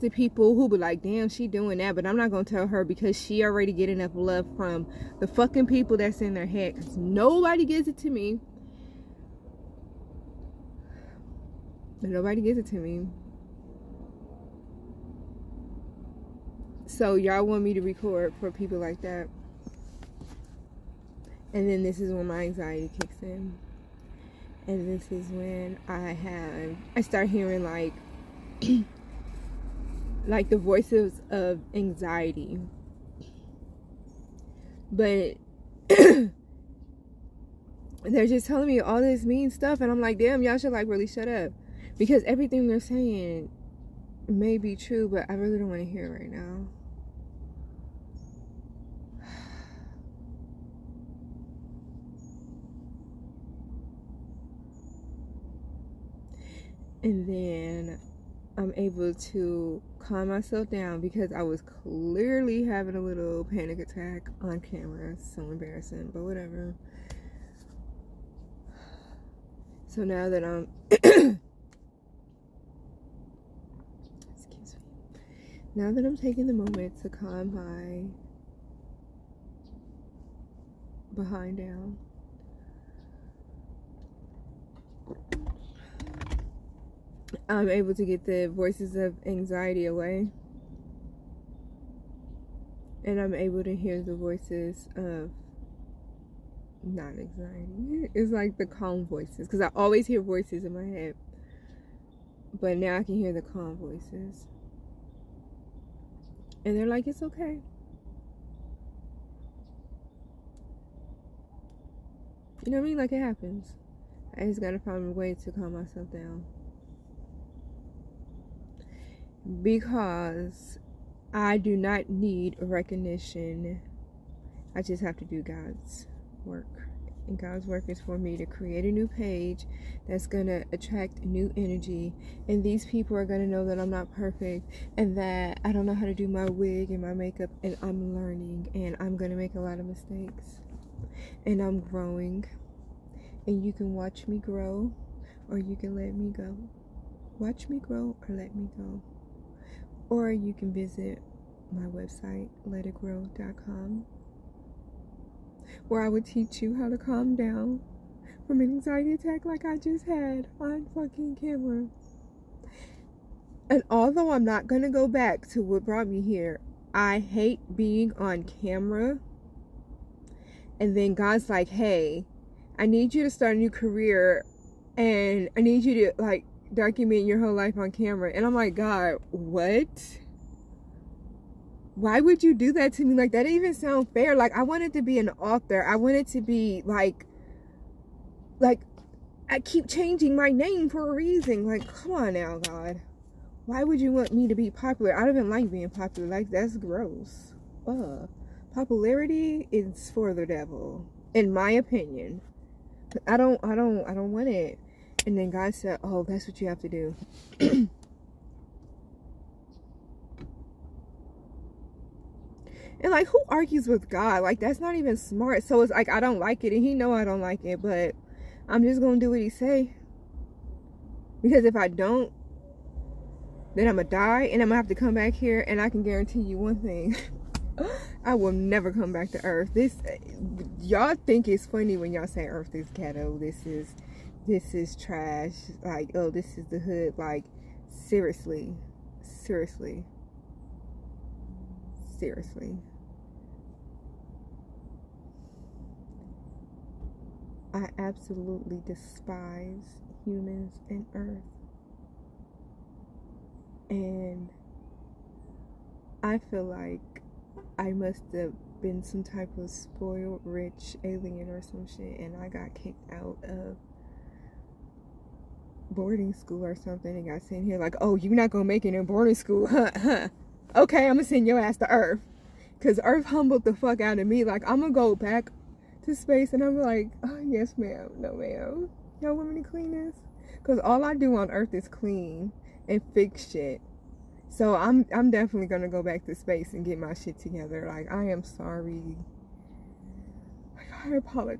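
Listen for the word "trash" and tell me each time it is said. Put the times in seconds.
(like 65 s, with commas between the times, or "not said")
234 s.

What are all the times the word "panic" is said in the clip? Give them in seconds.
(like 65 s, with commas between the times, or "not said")
63 s.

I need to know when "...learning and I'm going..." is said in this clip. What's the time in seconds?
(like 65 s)
138 s.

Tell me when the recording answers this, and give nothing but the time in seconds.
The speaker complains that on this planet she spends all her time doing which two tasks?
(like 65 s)
281 s.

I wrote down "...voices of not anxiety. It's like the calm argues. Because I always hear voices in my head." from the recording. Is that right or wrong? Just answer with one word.
wrong.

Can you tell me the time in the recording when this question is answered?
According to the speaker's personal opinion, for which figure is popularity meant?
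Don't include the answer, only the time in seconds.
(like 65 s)
200 s.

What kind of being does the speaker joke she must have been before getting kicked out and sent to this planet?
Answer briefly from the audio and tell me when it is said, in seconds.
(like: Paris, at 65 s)
spoiled rich alien, at 259 s.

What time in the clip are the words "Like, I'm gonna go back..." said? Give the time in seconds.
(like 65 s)
274 s.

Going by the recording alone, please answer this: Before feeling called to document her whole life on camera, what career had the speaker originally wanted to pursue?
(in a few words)
author.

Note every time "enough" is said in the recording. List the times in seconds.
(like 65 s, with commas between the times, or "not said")
3 s.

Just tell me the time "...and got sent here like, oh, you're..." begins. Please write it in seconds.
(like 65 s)
267 s.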